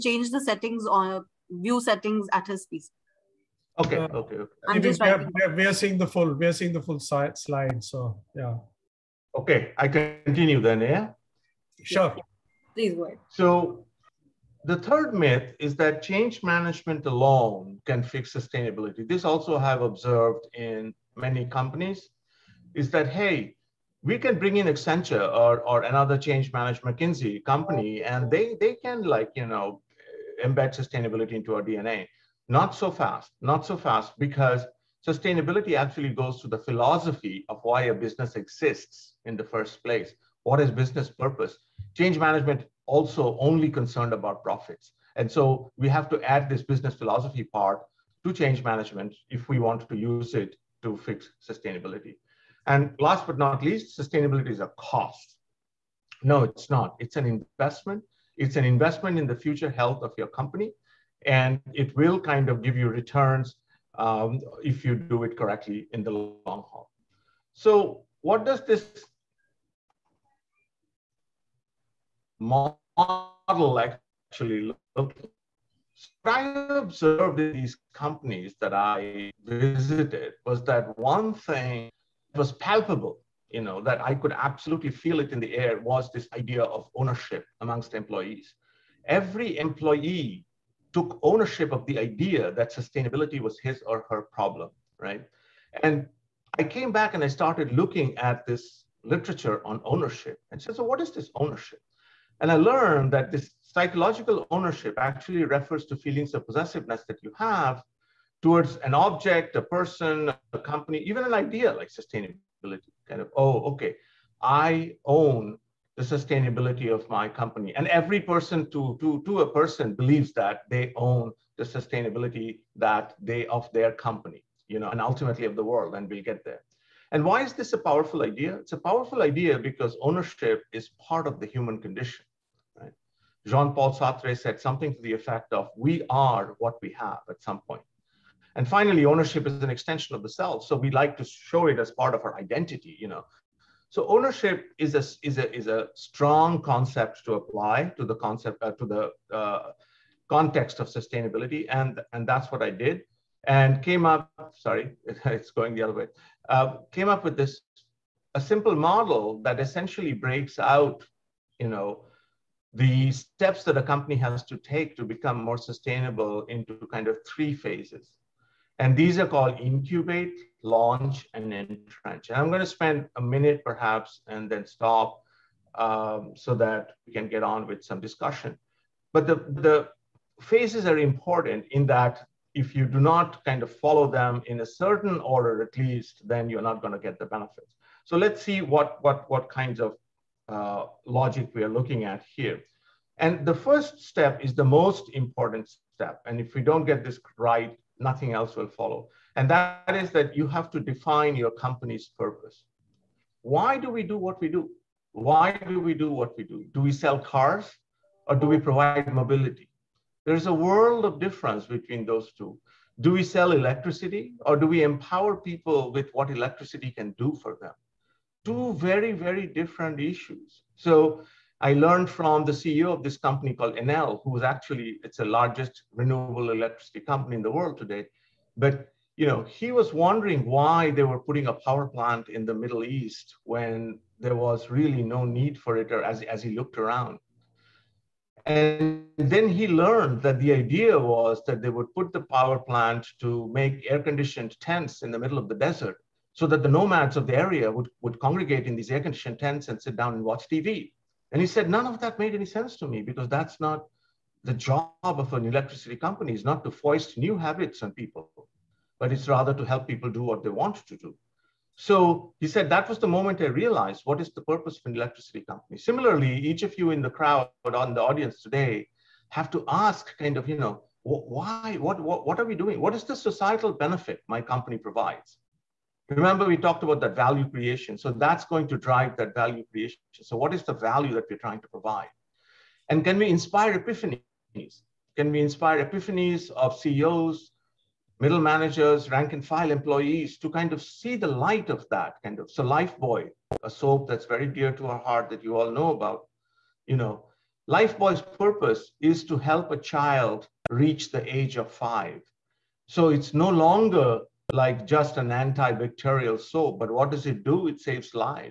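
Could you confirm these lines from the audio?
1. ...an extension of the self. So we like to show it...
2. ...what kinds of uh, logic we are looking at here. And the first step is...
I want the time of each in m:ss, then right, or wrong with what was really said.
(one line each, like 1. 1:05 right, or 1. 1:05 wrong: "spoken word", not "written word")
1. 2:19 right
2. 3:09 right.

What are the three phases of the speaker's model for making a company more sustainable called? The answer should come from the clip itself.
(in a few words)
Incubate, launch, and entrench.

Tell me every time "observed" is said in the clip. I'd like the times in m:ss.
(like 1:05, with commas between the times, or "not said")
0:19, 1:16.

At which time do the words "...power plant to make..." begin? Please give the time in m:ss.
4:02.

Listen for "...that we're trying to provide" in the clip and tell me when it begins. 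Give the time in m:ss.
4:41.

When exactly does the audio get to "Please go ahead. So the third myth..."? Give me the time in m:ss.
0:12.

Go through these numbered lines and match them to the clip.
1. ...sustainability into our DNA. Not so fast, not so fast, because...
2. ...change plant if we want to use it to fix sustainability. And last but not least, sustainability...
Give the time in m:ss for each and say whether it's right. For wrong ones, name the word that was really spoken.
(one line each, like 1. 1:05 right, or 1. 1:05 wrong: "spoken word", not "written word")
1. 0:30 right
2. 0:48 wrong: "management", not "plant".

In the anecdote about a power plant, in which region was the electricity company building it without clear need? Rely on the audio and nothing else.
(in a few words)
The Middle East.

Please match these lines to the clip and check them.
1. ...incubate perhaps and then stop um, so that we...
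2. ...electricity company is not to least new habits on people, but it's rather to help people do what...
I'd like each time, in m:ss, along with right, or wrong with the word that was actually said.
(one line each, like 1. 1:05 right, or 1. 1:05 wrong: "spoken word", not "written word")
1. 2:53 wrong: "minute", not "incubate"
2. 4:15 wrong: "foist", not "least".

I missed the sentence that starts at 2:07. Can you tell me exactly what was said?
And why is this a powerful idea?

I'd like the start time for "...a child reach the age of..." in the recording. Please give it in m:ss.
4:59.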